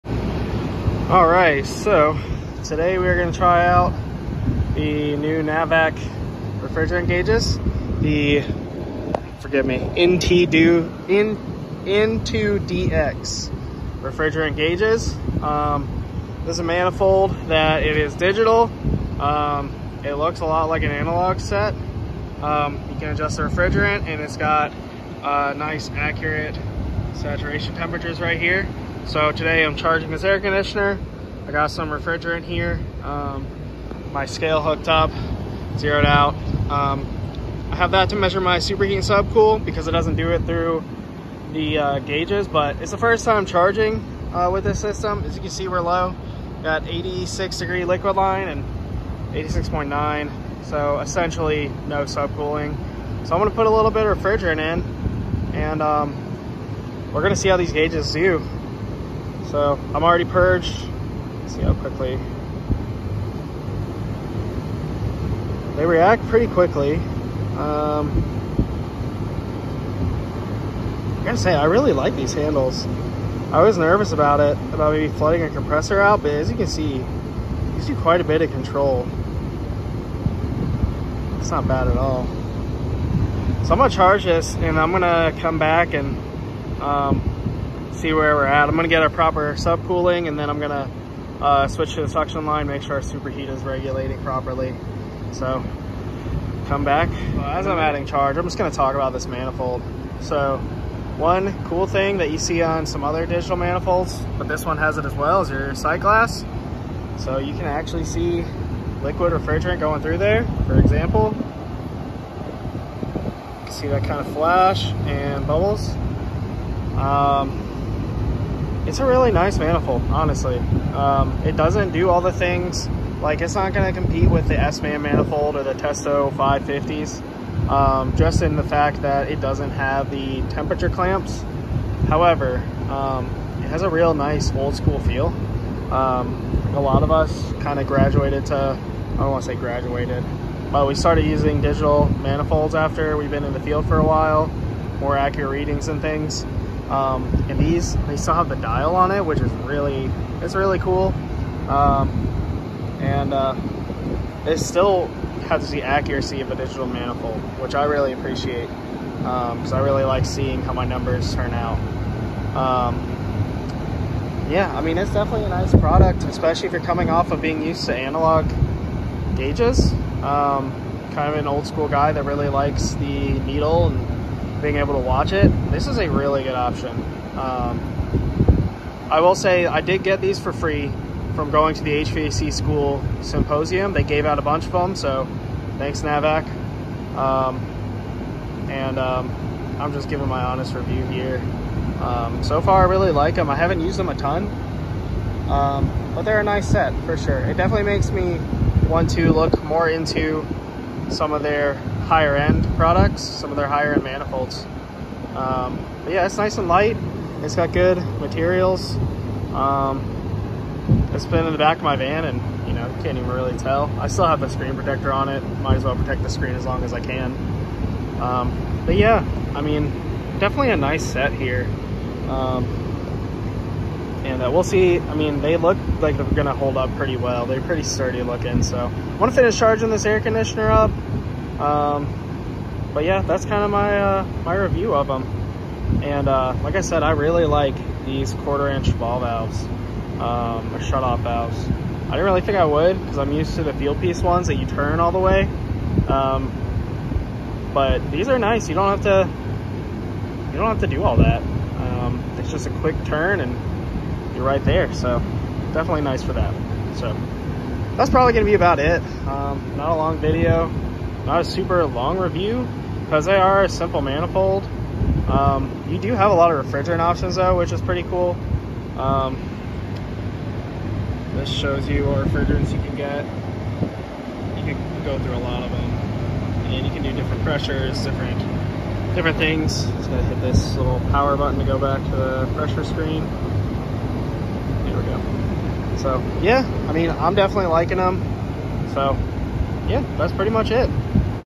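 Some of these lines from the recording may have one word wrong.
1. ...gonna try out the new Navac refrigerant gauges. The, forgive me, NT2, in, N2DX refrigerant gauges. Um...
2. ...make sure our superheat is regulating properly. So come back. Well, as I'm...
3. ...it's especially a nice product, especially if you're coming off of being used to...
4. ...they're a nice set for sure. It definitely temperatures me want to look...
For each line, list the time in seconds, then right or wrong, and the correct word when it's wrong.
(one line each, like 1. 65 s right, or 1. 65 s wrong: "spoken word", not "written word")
1. 3 s right
2. 92 s right
3. 164 s wrong: "definitely", not "especially"
4. 196 s wrong: "makes", not "temperatures".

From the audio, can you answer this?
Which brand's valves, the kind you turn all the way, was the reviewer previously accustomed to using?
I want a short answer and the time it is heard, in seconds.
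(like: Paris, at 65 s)
Fieldpiece, at 243 s.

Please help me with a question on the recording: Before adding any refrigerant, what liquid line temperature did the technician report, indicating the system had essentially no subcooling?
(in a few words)
86 degrees.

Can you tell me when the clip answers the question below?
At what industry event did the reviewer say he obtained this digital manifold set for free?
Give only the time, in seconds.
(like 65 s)
181 s.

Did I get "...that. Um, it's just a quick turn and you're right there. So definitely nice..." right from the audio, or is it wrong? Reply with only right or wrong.
right.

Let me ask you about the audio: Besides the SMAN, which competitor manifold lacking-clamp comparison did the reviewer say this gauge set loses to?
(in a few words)
Testo 550s.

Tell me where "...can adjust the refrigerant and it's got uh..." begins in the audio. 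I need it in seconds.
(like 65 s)
23 s.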